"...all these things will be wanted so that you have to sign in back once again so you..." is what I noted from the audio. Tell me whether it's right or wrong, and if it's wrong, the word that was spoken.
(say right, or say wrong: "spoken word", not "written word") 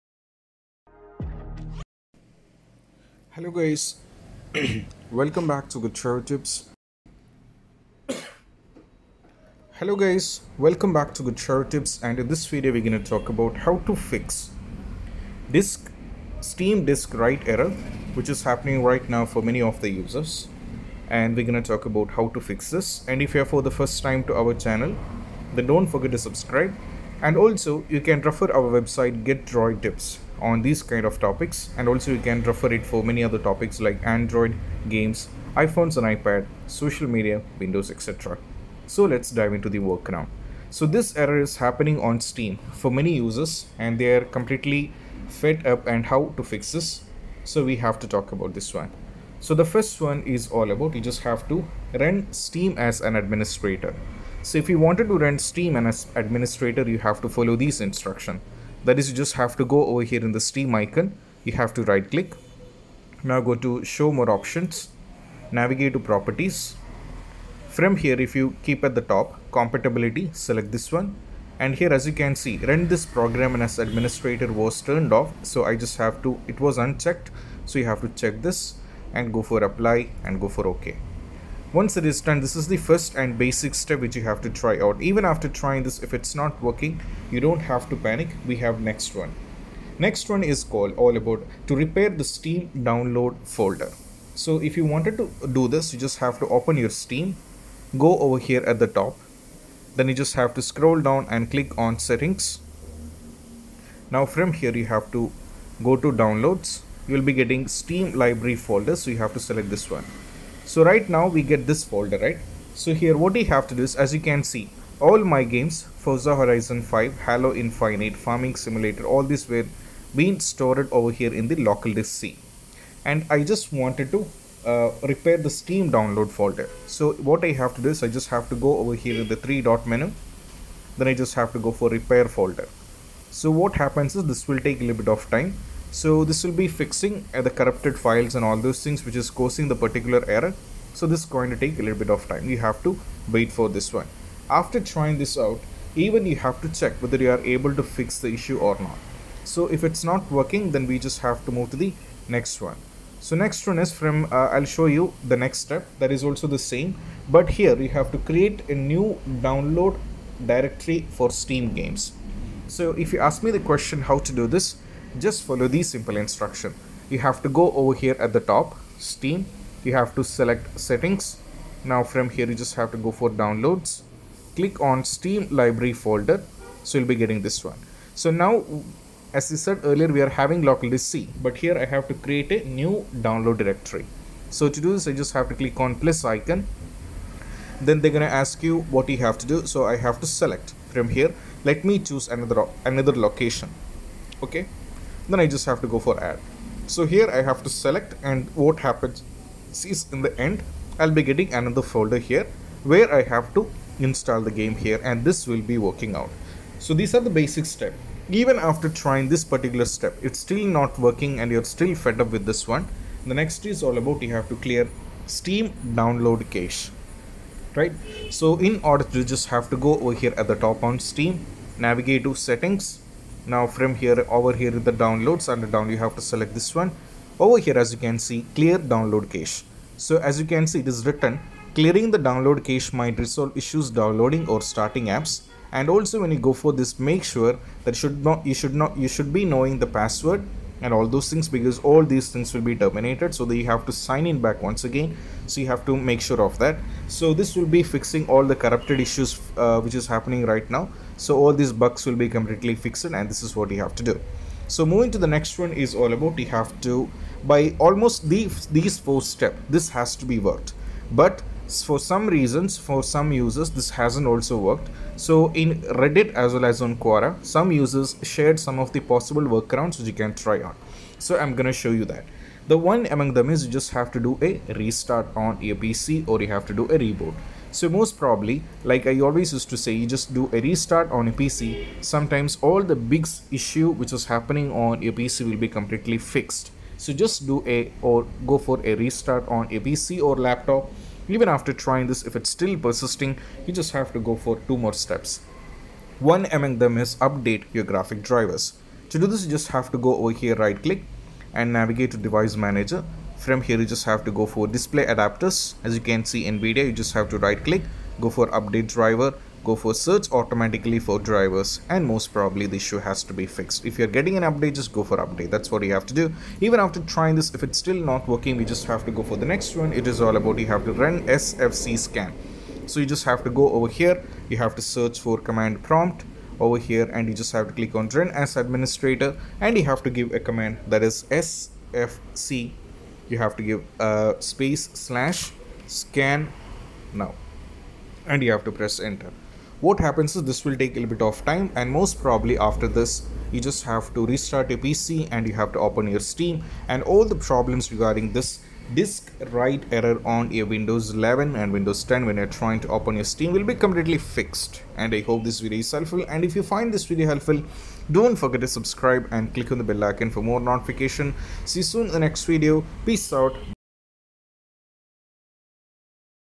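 wrong: "terminated", not "wanted".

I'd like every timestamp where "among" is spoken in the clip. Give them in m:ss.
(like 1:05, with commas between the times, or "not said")
4:33, 4:56.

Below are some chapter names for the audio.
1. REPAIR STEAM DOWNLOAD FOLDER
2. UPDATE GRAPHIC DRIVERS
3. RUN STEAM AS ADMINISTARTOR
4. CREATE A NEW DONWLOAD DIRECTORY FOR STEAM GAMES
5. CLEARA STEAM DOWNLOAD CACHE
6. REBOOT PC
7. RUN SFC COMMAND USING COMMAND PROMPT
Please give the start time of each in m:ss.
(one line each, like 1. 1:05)
1. 1:32
2. 4:57
3. 0:52
4. 2:38
5. 3:36
6. 4:36
7. 5:21.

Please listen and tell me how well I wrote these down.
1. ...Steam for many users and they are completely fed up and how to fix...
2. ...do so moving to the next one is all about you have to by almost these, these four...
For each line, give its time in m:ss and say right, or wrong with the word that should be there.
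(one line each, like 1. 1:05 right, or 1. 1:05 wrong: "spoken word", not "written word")
1. 0:42 right
2. 4:14 right.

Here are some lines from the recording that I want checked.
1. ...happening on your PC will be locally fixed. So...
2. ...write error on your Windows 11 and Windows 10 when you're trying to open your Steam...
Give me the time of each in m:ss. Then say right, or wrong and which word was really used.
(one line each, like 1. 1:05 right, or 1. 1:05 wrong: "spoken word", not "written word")
1. 4:44 wrong: "completely", not "locally"
2. 5:49 right.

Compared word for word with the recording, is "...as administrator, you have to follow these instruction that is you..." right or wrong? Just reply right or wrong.
right.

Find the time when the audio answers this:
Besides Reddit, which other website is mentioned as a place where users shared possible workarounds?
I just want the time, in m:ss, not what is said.
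4:26.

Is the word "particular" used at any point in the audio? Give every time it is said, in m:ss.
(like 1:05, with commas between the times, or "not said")
2:19, 3:29.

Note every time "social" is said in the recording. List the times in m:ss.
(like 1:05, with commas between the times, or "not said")
0:36.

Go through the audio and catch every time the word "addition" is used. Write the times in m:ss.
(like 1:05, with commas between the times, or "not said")
not said.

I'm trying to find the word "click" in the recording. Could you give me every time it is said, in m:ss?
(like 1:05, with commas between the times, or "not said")
1:02, 1:41, 2:54, 3:05, 5:00, 5:07, 5:27, 5:59.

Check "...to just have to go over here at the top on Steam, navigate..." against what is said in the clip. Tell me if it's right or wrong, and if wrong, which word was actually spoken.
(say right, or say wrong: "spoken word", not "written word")
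right.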